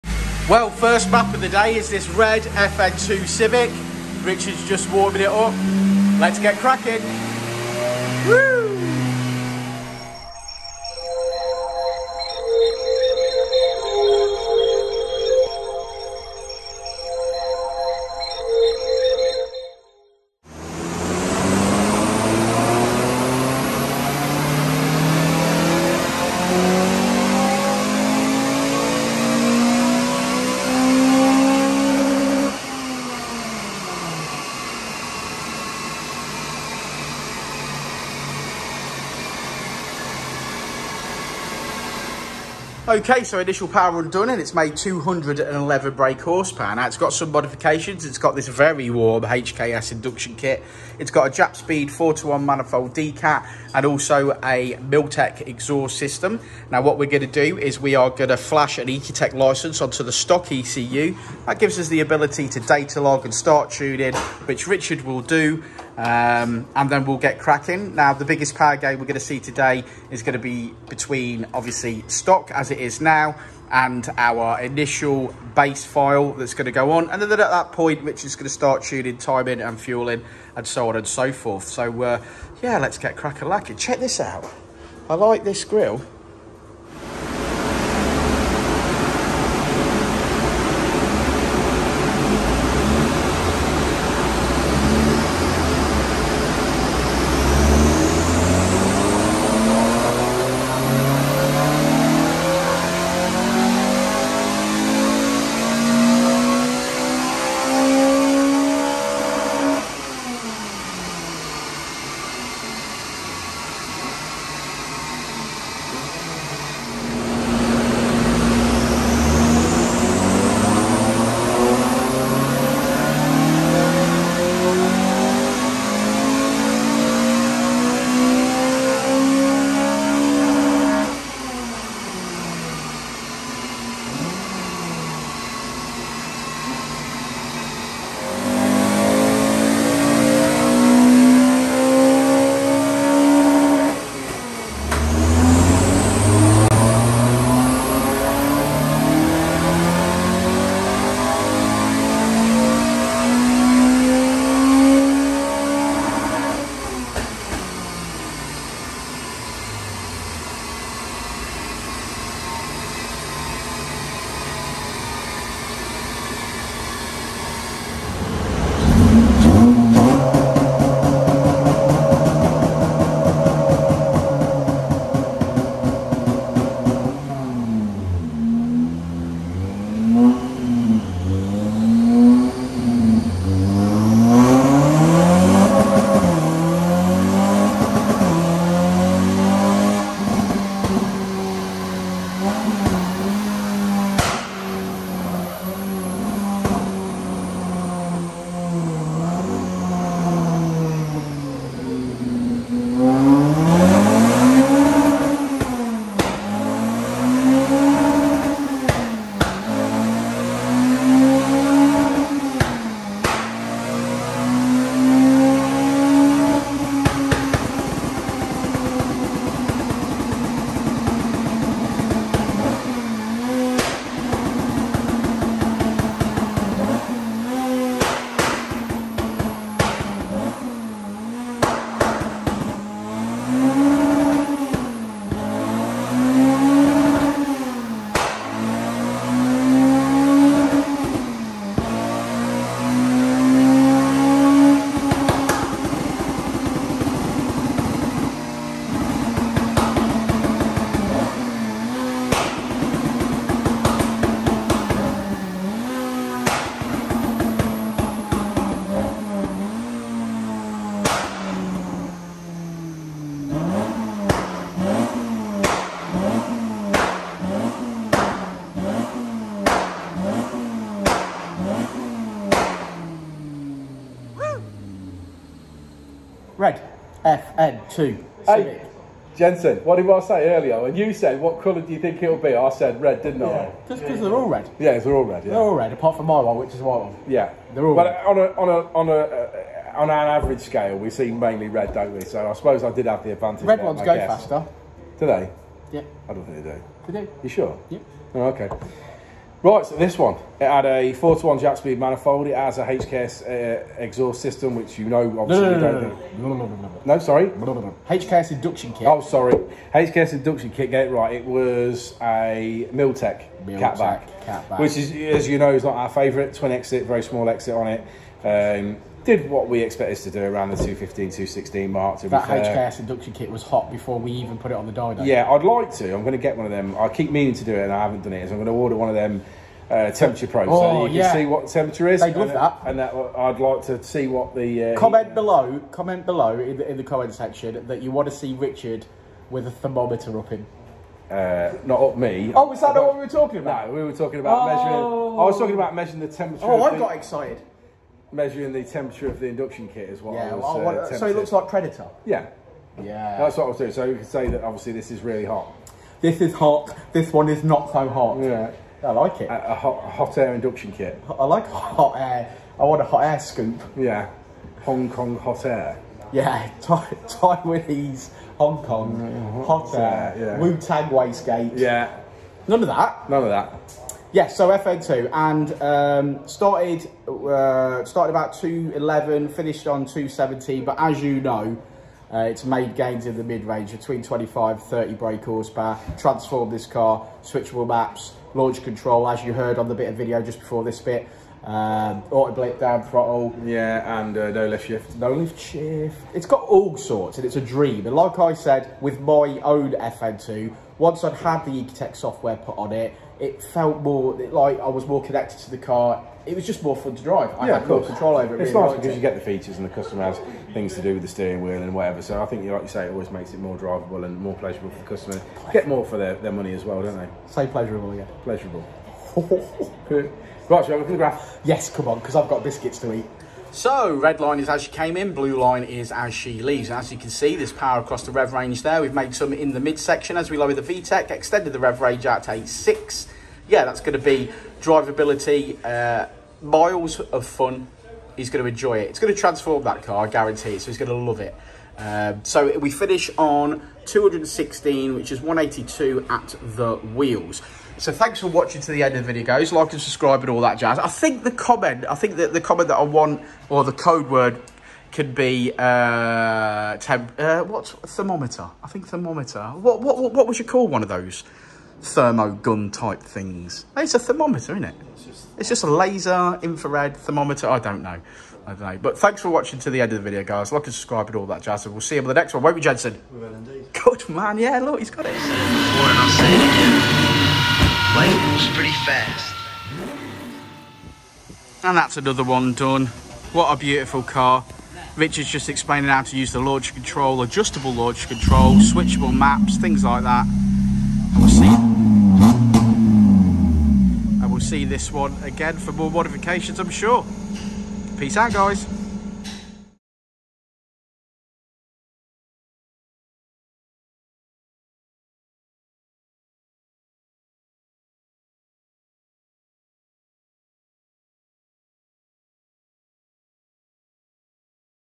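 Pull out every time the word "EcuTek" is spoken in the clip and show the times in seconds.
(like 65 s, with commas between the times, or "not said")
58 s, 401 s.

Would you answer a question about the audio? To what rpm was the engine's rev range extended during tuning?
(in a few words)
8,600.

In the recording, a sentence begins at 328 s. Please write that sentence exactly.
So I'm going to order one of them uh, temperature probes oh, so you yeah.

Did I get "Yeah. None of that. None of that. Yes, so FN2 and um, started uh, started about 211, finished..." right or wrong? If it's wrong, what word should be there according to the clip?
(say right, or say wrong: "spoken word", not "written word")
right.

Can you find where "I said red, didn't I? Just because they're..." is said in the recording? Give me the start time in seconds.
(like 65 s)
282 s.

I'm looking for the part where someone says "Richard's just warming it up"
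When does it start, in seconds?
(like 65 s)
4 s.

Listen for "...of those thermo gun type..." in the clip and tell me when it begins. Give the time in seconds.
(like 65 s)
461 s.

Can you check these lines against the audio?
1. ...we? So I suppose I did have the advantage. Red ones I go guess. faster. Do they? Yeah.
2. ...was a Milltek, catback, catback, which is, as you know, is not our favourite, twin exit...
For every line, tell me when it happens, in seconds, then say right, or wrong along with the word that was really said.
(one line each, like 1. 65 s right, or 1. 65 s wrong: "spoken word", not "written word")
1. 292 s right
2. 311 s right.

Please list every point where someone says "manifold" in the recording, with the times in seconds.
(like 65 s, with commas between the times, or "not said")
52 s, 301 s.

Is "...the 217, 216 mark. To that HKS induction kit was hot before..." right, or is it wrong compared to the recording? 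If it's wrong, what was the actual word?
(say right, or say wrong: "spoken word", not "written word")
wrong: "215", not "217".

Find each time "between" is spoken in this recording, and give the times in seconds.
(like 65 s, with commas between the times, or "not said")
70 s, 383 s.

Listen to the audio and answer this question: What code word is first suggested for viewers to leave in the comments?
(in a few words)
Temp.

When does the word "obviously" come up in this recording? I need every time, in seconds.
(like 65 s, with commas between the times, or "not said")
71 s, 305 s, 354 s.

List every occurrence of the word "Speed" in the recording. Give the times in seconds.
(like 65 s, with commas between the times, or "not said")
51 s, 301 s.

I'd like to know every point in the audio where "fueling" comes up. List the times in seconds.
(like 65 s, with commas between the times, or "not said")
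79 s.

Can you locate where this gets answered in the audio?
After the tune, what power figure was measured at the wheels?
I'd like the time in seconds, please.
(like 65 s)
445 s.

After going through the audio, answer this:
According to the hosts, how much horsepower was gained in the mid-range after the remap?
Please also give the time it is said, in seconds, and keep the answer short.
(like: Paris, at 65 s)
25 to 30, at 384 s.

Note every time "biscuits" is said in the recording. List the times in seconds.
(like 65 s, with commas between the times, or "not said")
422 s.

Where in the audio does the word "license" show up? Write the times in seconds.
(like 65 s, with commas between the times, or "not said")
59 s.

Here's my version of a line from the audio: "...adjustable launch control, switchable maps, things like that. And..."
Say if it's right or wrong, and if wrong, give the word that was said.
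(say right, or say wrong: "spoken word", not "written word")
right.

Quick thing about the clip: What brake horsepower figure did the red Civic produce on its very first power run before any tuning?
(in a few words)
211.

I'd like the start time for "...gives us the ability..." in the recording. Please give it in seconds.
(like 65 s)
61 s.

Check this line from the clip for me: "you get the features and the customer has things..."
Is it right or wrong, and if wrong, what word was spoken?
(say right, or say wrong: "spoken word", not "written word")
right.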